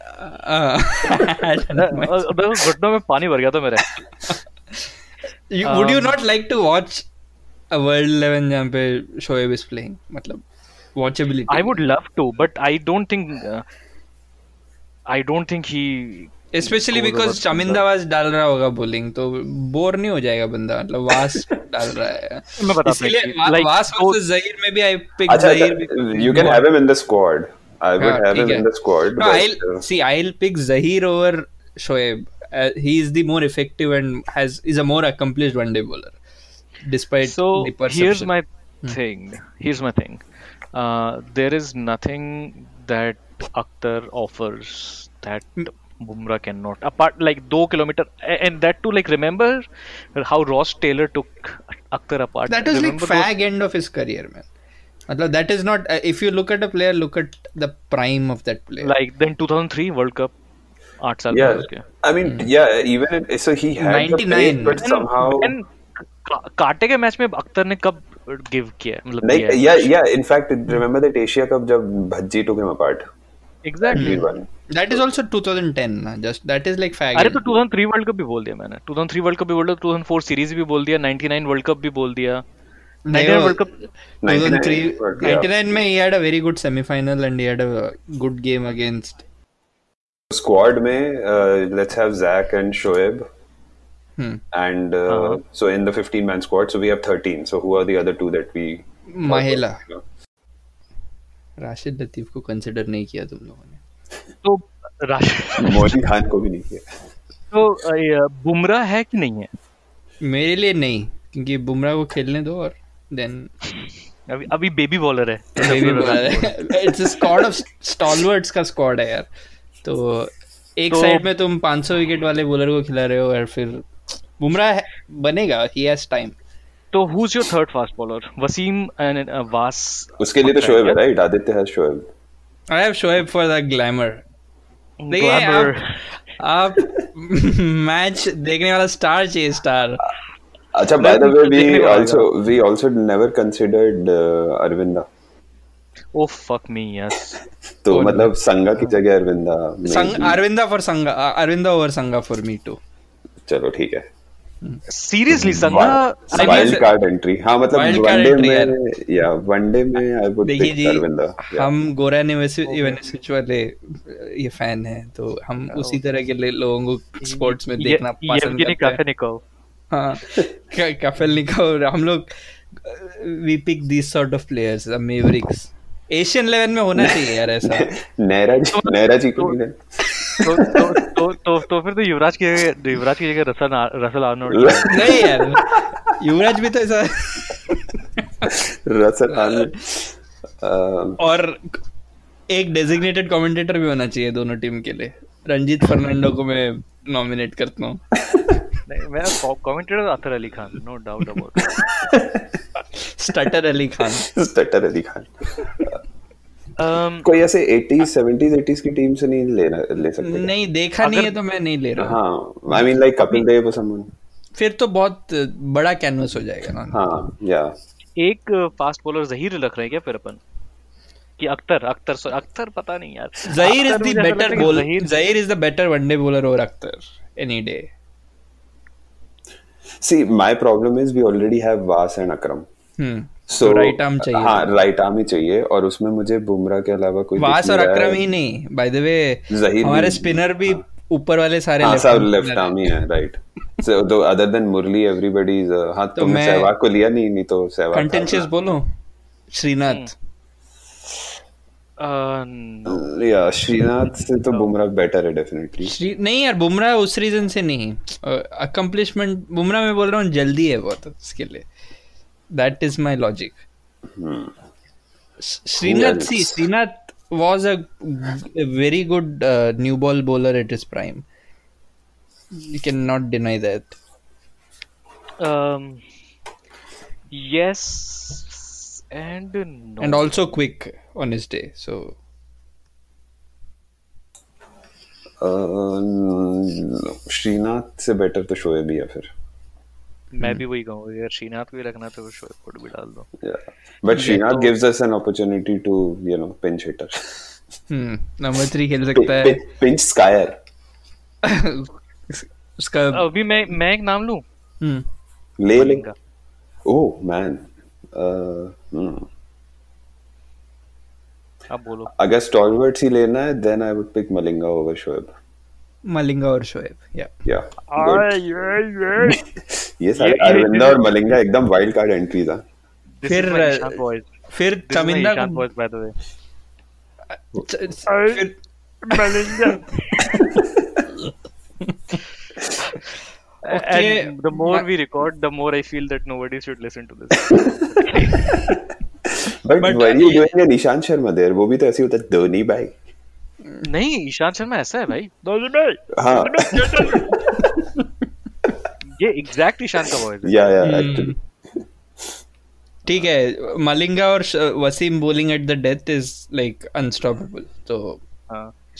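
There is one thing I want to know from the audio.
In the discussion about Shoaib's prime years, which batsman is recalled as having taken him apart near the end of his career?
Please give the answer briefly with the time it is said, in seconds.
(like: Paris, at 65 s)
Ross Taylor, at 50 s.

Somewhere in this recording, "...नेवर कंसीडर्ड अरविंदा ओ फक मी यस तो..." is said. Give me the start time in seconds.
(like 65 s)
143 s.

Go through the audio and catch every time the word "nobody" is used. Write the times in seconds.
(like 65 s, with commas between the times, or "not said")
336 s.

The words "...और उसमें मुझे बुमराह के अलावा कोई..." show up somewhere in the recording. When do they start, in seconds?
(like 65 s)
235 s.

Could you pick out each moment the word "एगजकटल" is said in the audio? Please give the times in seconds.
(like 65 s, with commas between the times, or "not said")
73 s, 349 s.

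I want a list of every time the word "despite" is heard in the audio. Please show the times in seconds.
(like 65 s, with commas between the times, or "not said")
36 s.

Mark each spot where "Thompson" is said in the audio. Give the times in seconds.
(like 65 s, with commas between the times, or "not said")
not said.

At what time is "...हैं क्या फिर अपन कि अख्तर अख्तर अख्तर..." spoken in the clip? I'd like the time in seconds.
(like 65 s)
219 s.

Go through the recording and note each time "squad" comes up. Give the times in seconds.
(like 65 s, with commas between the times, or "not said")
90 s, 96 s.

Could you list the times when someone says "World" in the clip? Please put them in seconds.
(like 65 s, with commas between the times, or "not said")
60 s, 83 s.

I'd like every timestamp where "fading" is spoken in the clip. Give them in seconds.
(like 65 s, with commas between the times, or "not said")
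not said.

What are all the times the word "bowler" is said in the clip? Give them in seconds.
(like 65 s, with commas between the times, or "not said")
35 s, 270 s.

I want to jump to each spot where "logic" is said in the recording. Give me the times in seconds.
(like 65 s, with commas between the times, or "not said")
263 s.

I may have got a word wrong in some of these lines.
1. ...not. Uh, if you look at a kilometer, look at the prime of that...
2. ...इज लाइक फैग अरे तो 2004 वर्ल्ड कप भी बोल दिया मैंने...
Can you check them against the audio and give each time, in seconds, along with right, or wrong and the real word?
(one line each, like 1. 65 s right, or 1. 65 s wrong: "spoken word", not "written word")
1. 55 s wrong: "player", not "kilometer"
2. 76 s wrong: "2003", not "2004".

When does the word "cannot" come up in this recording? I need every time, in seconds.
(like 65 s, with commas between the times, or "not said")
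46 s, 272 s.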